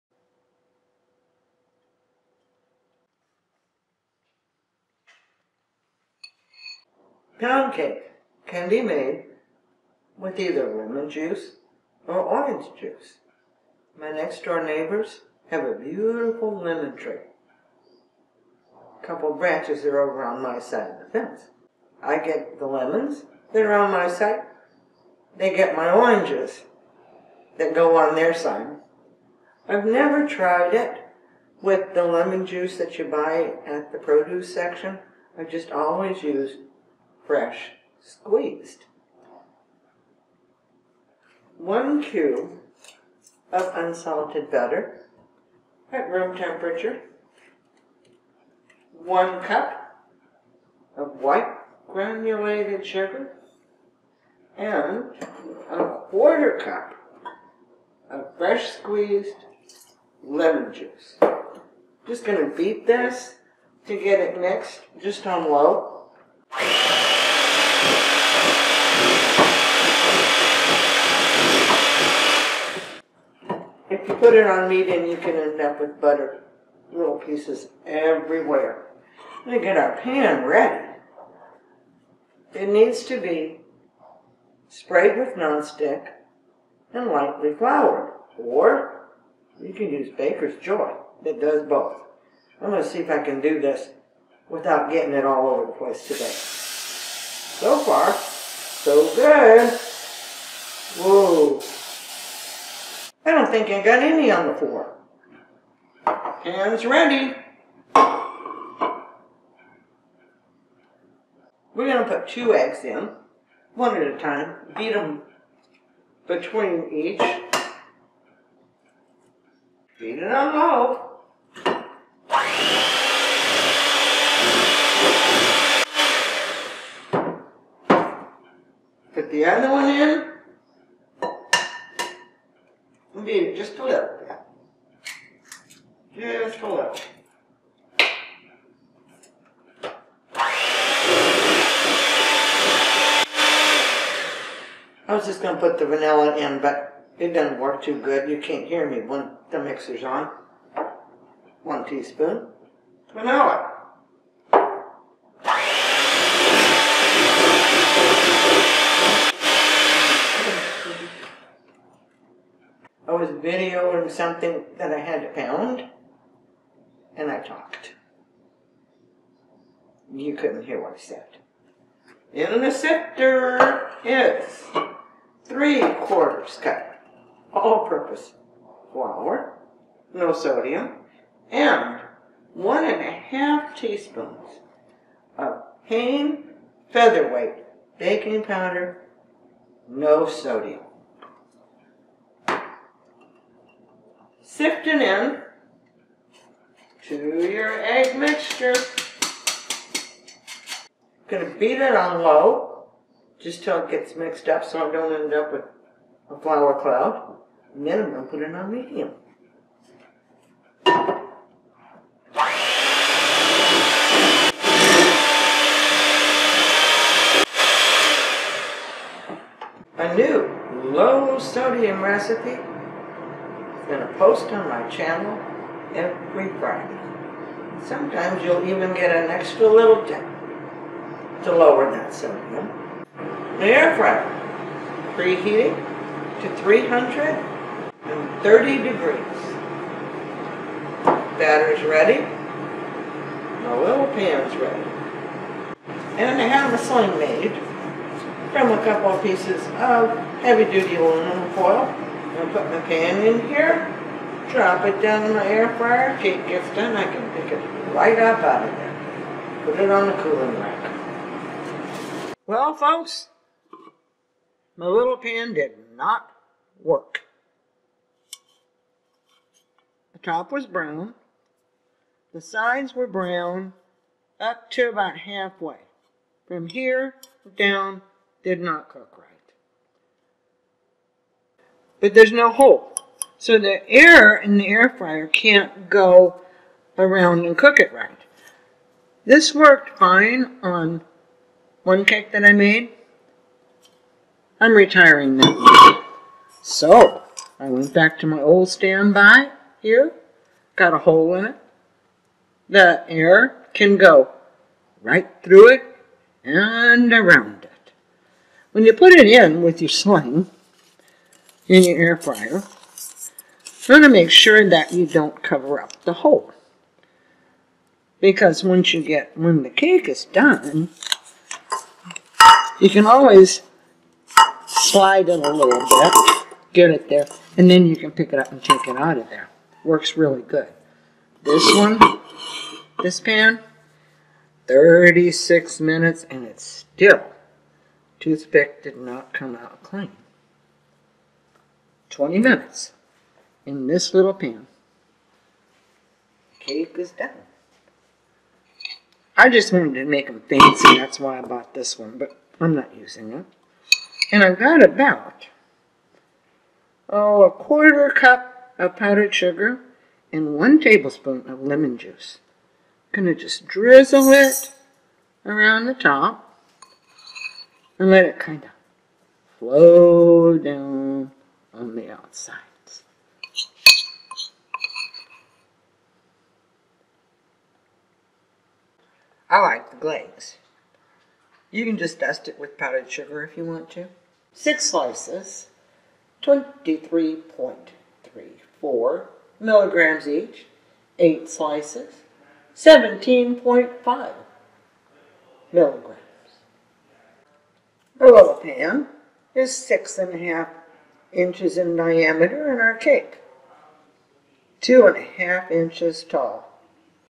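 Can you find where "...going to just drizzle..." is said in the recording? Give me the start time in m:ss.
6:03.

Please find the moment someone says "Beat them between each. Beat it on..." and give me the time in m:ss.
1:54.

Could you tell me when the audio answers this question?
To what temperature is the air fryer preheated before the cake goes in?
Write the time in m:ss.
3:56.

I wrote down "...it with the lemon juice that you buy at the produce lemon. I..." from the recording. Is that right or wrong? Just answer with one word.
wrong.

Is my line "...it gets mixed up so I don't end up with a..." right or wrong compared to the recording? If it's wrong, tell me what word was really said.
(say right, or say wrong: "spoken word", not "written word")
right.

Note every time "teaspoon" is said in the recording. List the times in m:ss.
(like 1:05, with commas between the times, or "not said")
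2:31, 3:03.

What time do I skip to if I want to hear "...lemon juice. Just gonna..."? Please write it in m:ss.
1:00.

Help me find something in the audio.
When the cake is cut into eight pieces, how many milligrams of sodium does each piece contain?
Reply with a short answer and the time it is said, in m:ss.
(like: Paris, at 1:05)
17.5 milligrams, at 6:32.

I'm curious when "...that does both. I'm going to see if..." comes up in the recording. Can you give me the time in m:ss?
1:31.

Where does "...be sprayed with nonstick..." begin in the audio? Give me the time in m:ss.
1:23.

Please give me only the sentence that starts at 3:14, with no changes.
sifting in to your egg mixture.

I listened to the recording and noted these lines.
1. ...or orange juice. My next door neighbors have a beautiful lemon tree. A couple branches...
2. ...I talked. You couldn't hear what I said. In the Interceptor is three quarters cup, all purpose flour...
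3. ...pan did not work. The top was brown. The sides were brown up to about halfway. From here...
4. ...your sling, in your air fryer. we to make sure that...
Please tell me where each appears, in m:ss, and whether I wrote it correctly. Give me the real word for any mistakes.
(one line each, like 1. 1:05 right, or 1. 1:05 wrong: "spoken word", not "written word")
1. 0:12 right
2. 2:47 right
3. 4:25 right
4. 5:09 right.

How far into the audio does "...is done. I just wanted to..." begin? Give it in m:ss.
5:46.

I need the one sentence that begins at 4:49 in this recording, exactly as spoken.
This worked fine on one cake that I made.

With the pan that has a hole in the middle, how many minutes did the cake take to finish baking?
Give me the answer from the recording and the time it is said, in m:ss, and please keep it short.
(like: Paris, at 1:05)
20 minutes, at 5:42.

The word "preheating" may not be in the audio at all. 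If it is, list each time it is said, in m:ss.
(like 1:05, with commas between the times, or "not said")
3:55.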